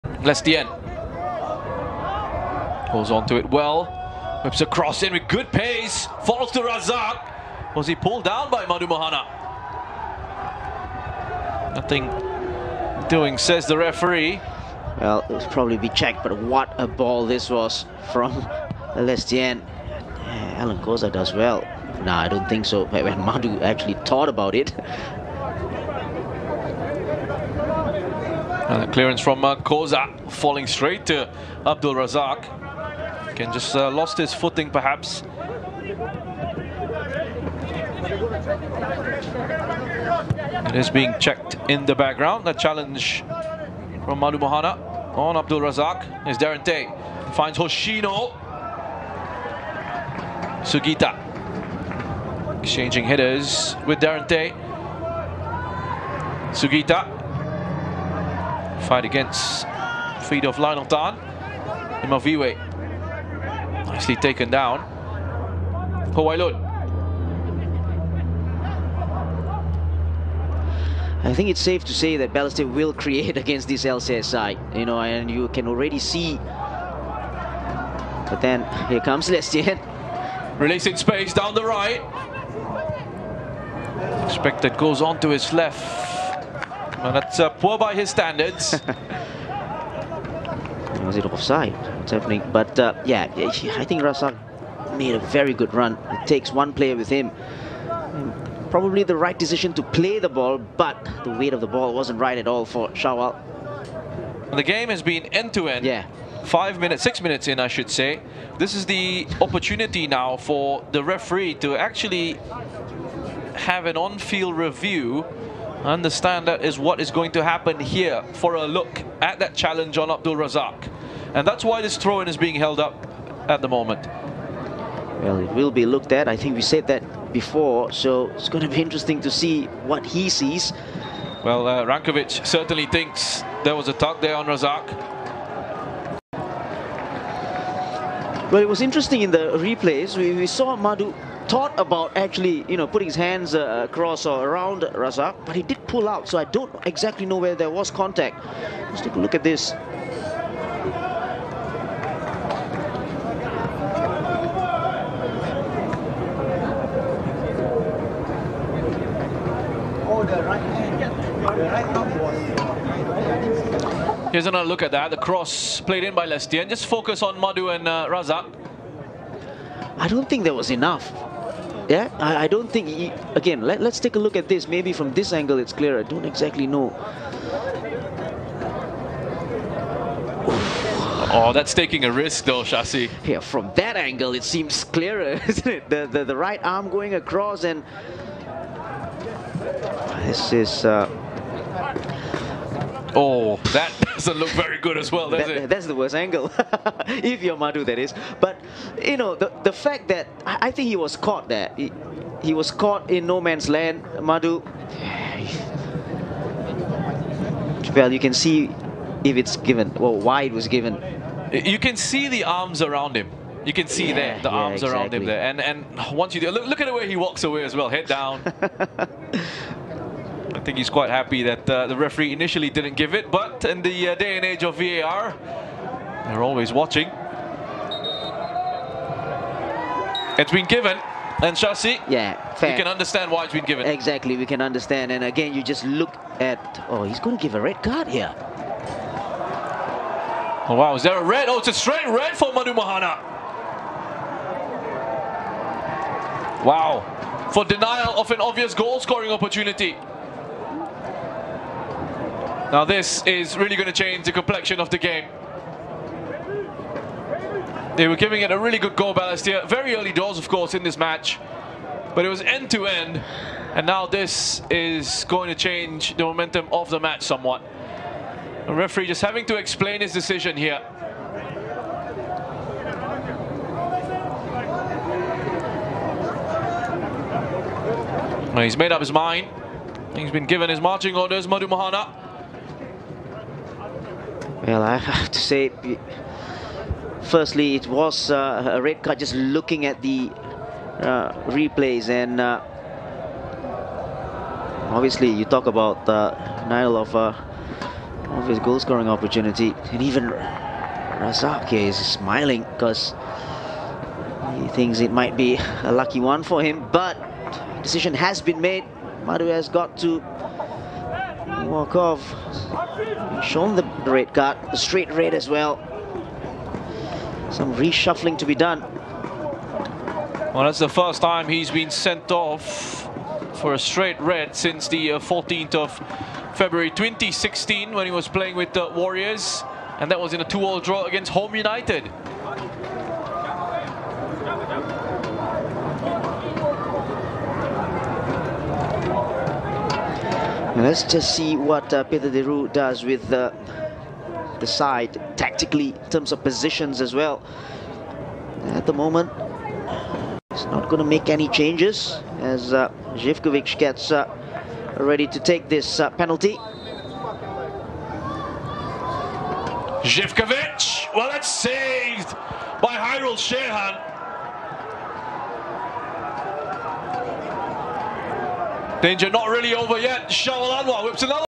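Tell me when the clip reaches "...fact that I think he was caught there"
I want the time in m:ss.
3:19.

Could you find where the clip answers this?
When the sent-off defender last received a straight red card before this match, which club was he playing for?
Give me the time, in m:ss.
5:28.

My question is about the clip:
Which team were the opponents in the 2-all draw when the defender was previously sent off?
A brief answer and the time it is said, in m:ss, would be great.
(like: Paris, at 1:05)
Home United, at 5:31.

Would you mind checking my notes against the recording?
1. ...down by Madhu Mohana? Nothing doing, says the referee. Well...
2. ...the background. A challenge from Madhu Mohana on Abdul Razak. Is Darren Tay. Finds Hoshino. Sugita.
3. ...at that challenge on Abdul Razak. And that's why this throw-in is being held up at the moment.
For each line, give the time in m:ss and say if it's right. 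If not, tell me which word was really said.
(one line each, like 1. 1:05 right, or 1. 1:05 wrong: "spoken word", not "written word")
1. 0:08 right
2. 0:41 right
3. 1:59 right.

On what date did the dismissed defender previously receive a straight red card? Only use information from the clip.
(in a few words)
14 February 2016.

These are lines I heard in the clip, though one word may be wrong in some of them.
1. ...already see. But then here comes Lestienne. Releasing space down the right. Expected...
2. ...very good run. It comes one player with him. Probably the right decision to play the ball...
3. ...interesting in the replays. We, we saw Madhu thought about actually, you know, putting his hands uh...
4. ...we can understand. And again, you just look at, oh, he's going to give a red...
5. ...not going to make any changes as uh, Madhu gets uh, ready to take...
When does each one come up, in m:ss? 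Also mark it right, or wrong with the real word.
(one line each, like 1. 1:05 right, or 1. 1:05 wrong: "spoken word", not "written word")
1. 1:15 right
2. 1:35 wrong: "takes", not "comes"
3. 2:18 right
4. 3:54 right
5. 5:50 wrong: "Zivkovic", not "Madhu".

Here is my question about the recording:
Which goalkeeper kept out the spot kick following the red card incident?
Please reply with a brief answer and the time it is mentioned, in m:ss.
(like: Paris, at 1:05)
Hairul Syirhan, at 6:02.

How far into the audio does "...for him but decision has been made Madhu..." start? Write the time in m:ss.
5:06.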